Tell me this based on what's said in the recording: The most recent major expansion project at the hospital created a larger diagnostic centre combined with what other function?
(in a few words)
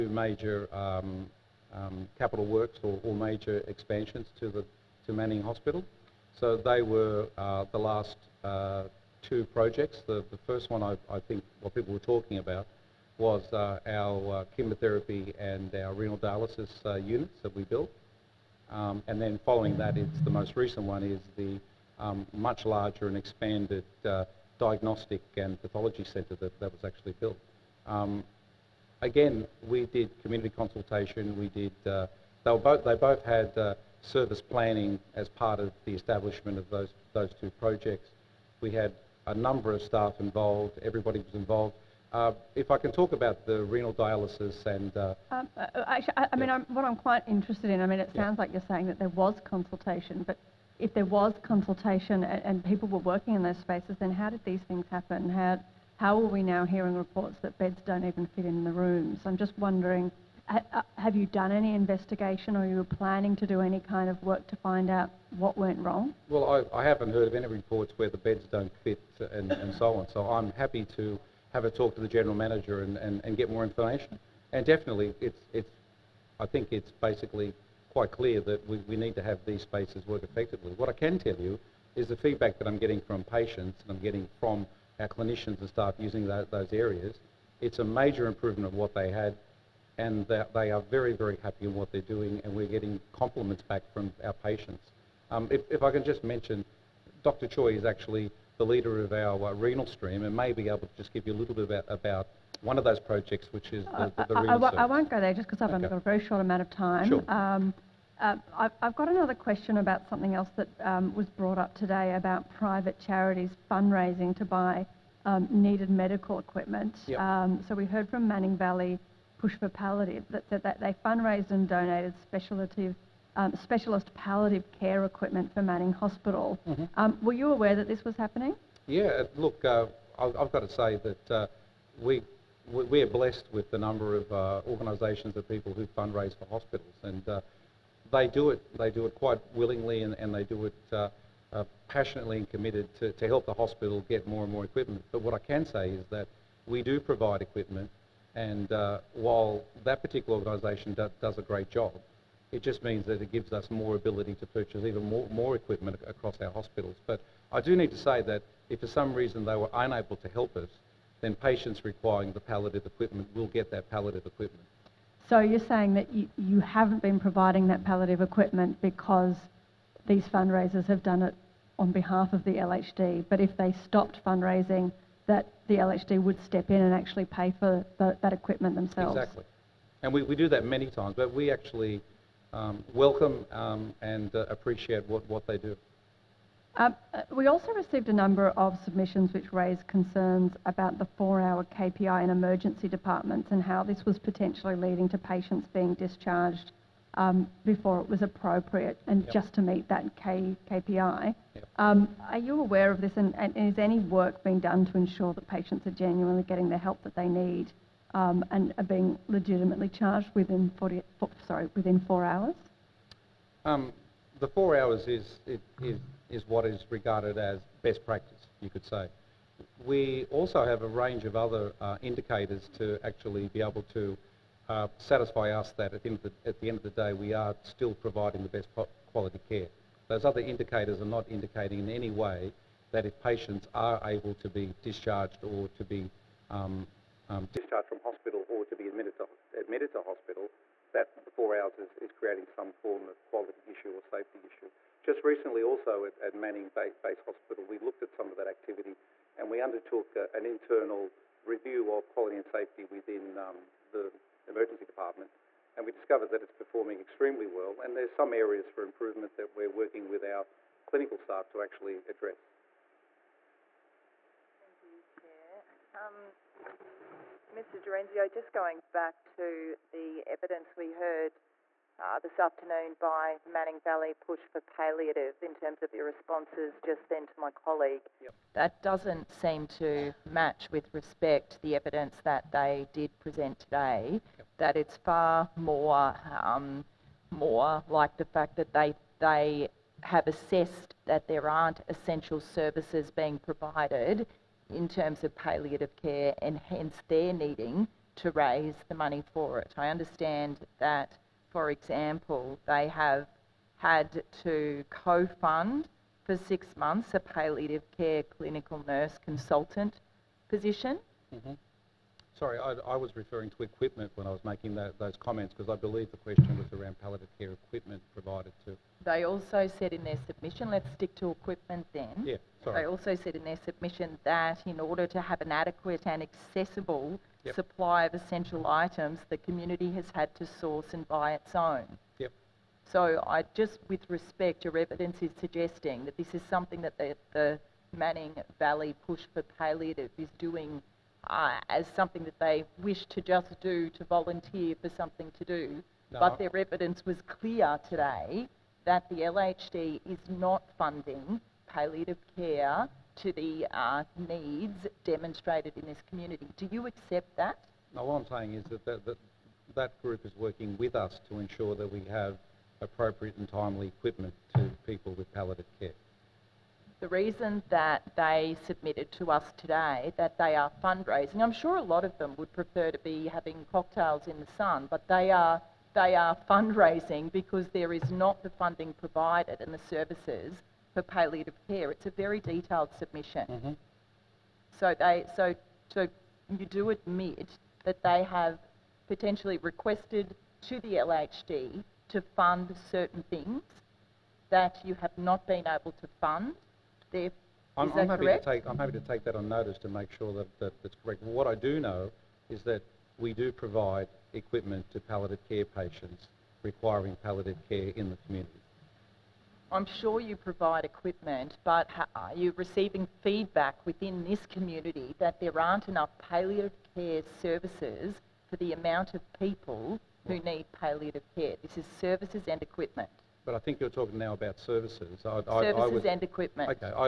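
pathology.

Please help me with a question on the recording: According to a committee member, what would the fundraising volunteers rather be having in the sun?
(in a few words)
cocktails.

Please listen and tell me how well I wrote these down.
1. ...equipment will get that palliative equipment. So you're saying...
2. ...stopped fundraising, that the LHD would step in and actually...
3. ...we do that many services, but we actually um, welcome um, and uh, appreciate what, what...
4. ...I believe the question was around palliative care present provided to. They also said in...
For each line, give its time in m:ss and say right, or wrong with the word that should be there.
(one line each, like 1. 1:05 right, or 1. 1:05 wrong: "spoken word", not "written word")
1. 2:42 right
2. 2:53 right
3. 3:00 wrong: "times", not "services"
4. 5:15 wrong: "equipment", not "present".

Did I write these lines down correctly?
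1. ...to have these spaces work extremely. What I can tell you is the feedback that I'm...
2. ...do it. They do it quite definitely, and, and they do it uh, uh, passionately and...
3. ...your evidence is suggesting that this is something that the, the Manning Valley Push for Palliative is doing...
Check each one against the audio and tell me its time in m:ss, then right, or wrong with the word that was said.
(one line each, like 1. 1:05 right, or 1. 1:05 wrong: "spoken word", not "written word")
1. 1:19 wrong: "effectively", not "extremely"
2. 2:18 wrong: "willingly", not "definitely"
3. 5:34 right.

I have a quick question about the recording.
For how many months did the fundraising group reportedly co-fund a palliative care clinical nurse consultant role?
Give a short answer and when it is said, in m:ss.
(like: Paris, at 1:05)
6, at 5:06.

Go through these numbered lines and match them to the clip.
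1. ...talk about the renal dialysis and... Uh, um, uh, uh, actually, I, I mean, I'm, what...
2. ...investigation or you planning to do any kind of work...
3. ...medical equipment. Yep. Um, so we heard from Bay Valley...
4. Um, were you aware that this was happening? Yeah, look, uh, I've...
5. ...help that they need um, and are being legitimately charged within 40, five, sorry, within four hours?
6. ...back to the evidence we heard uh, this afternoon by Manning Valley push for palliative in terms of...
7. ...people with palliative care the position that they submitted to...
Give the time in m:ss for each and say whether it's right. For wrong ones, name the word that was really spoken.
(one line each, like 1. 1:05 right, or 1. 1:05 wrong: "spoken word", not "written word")
1. 0:42 right
2. 1:01 right
3. 1:55 wrong: "Manning", not "Bay"
4. 2:06 right
5. 3:26 wrong: "four", not "five"
6. 4:28 right
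7. 6:04 wrong: "reason", not "position".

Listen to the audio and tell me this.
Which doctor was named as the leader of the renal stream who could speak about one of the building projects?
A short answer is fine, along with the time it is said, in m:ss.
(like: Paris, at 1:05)
Dr. Choi, at 1:37.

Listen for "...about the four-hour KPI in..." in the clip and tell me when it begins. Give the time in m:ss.
3:10.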